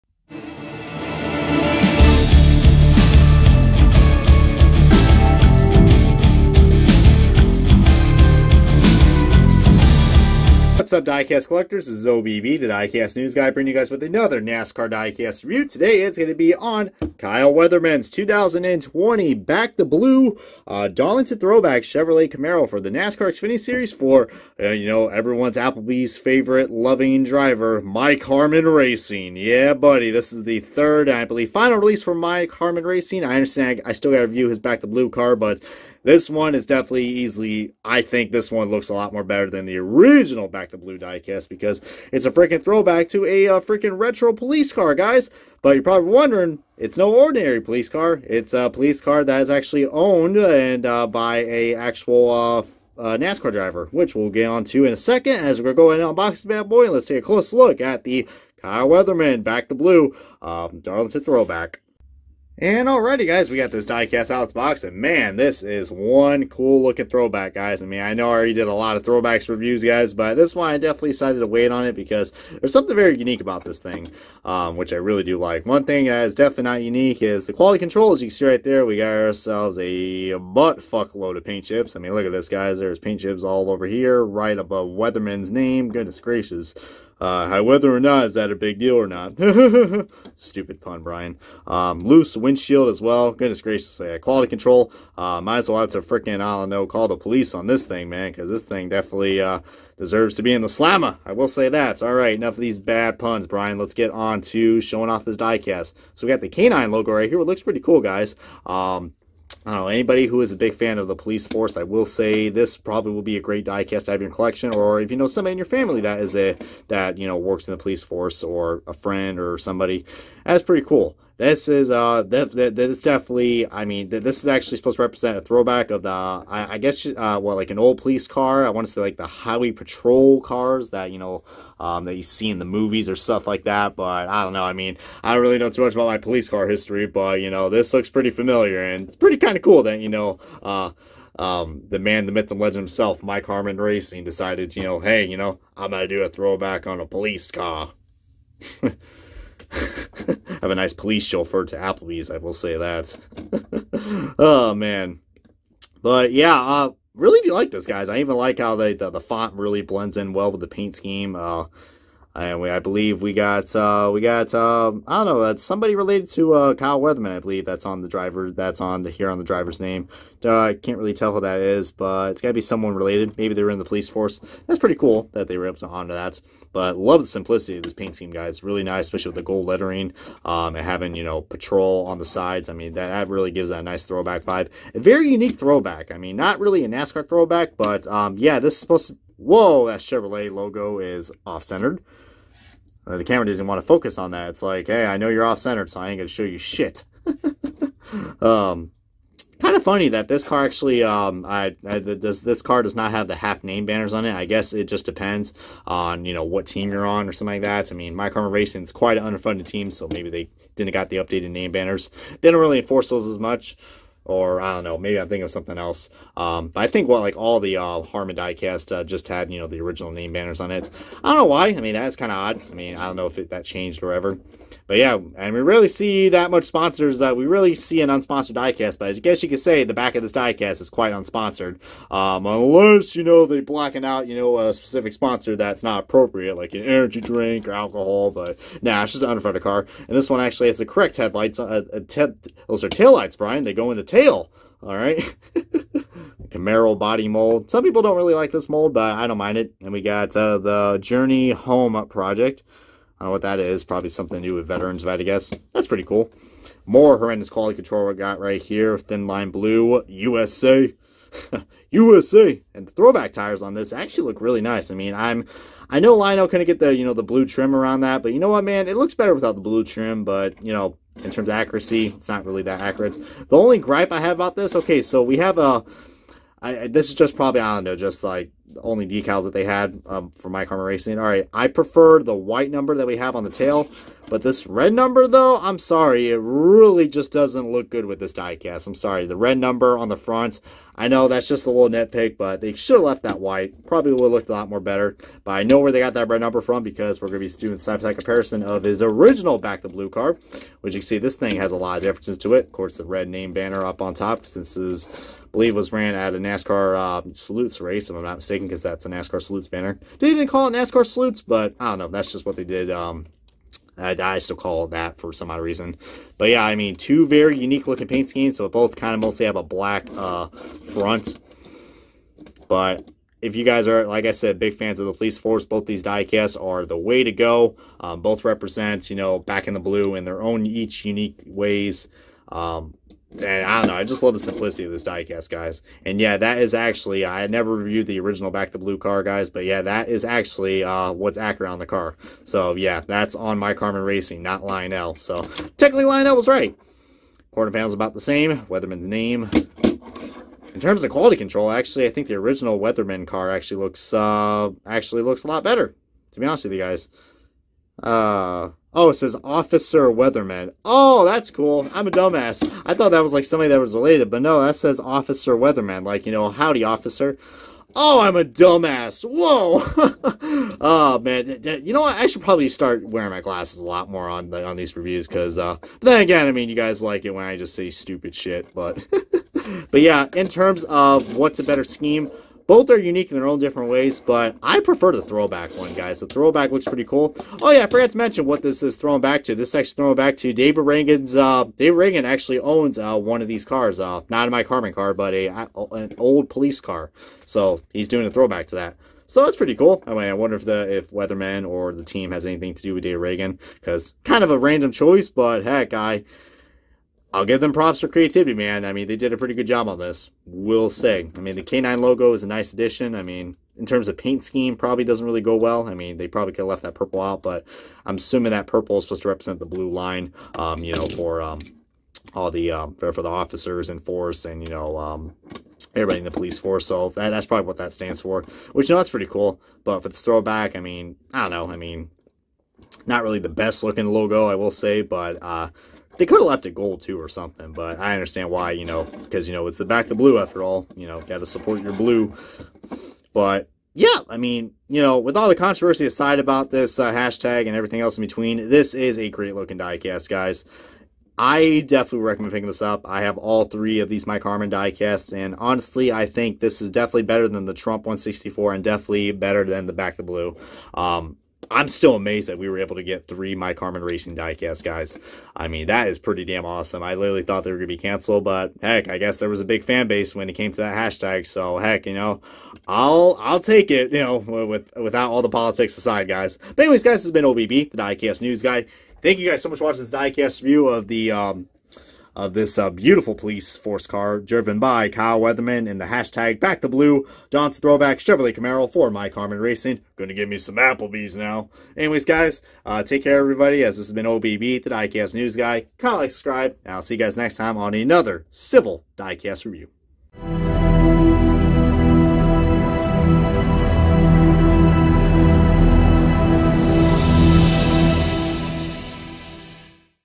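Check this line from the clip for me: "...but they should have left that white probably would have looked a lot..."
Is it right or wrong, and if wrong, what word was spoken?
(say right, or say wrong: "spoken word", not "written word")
right.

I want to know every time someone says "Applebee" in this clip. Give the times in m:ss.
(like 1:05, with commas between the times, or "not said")
0:25, 2:31, 8:10.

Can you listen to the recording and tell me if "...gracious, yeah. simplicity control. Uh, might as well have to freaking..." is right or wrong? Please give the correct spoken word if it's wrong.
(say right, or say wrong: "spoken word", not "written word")
wrong: "quality", not "simplicity".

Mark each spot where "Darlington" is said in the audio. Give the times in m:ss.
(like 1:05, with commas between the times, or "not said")
0:20, 1:00.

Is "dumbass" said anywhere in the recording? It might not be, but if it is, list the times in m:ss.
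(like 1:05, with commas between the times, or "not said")
6:02, 6:08.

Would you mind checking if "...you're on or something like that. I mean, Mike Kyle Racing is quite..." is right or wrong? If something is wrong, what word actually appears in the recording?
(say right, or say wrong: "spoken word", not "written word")
wrong: "Harmon", not "Kyle".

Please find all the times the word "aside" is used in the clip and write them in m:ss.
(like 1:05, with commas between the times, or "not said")
7:26, 7:55.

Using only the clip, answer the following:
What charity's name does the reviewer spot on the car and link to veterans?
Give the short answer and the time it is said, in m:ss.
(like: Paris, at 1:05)
Journey Home Project, at 4:11.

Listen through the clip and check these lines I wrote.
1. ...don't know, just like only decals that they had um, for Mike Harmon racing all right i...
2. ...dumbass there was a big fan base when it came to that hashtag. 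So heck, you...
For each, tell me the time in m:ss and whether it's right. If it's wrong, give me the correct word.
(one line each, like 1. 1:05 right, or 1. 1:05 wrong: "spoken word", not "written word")
1. 4:37 right
2. 7:49 wrong: "guess", not "dumbass".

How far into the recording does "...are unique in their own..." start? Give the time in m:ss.
6:22.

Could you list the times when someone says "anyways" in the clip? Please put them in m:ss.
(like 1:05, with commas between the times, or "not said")
7:56, 8:11.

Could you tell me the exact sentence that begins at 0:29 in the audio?
Yeah, buddy, this is the third, I believe, final release for Mike Harmon Racing.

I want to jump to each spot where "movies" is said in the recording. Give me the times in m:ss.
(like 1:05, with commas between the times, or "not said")
2:12.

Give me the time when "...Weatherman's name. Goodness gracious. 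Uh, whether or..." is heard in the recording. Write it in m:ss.
1:24.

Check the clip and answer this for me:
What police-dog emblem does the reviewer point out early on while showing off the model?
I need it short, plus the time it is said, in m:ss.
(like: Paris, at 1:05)
canine logo, at 1:46.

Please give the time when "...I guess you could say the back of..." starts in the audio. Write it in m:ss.
3:49.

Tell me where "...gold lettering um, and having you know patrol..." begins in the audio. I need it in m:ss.
2:59.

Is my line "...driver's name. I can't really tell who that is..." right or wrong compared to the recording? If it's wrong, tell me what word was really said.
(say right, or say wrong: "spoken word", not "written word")
right.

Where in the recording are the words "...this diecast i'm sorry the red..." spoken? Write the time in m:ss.
4:48.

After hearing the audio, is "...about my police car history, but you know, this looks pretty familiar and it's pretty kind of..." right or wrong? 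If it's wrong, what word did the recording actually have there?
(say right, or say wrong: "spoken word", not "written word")
right.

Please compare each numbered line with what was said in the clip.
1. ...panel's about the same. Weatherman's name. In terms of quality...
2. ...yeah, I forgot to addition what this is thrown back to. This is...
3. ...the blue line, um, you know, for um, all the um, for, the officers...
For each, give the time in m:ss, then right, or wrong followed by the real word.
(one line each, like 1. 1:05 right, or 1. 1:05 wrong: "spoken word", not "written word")
1. 5:47 right
2. 6:27 wrong: "mention", not "addition"
3. 6:59 right.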